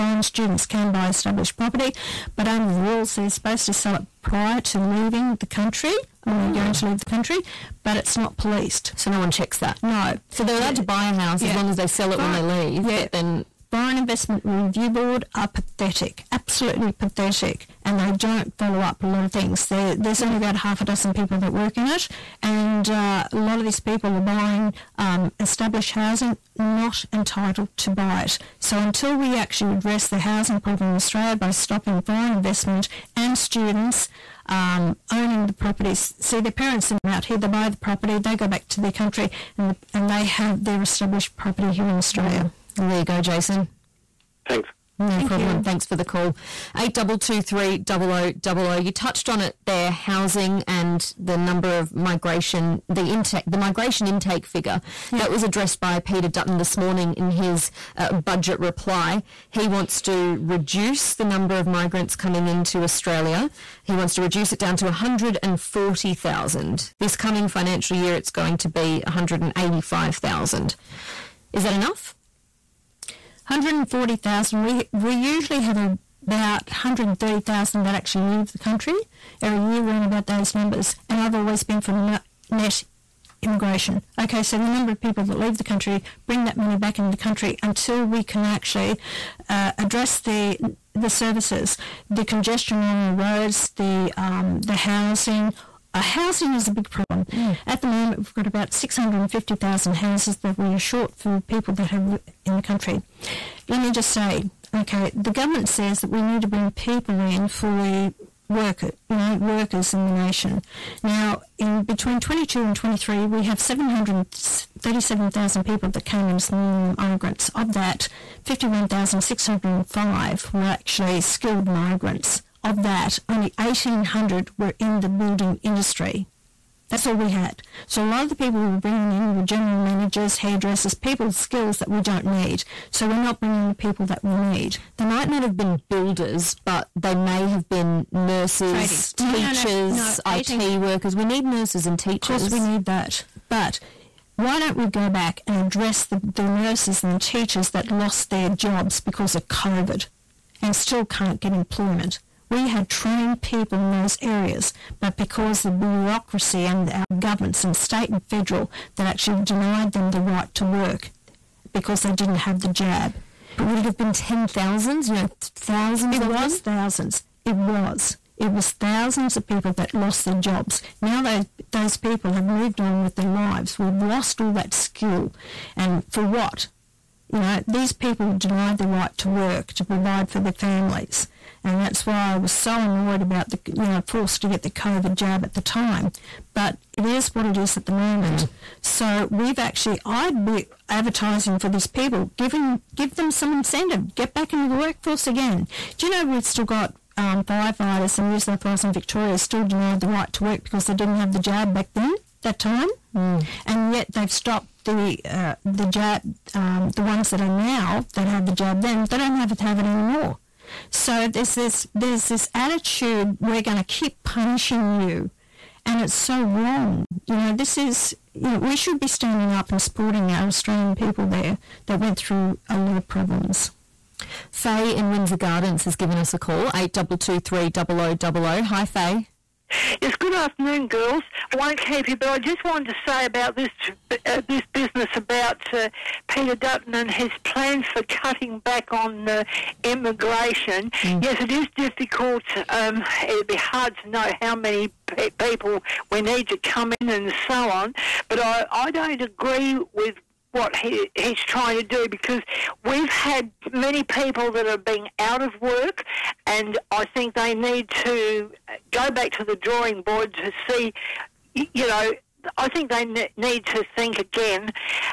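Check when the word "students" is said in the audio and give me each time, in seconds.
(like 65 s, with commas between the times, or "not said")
0 s, 33 s.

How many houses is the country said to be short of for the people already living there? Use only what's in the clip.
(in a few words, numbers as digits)
650,000.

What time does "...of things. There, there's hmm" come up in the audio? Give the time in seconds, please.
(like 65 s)
19 s.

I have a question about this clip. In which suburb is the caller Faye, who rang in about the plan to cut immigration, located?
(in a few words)
Windsor Gardens.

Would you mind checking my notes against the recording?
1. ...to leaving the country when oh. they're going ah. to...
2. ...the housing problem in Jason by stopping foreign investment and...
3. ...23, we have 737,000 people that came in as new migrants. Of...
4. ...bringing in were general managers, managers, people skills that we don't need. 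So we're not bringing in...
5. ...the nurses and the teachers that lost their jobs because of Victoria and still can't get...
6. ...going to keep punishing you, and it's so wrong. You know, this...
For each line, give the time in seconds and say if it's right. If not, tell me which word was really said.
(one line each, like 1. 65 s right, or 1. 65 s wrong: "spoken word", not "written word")
1. 4 s right
2. 30 s wrong: "Australia", not "Jason"
3. 112 s right
4. 128 s wrong: "hairdressers", not "managers"
5. 146 s wrong: "COVID", not "Victoria"
6. 213 s right.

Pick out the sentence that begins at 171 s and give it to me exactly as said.
Now those those people have moved on with their lives.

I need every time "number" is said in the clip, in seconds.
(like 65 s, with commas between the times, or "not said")
51 s, 61 s, 80 s, 84 s.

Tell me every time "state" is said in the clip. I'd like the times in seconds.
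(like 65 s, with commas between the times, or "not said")
157 s.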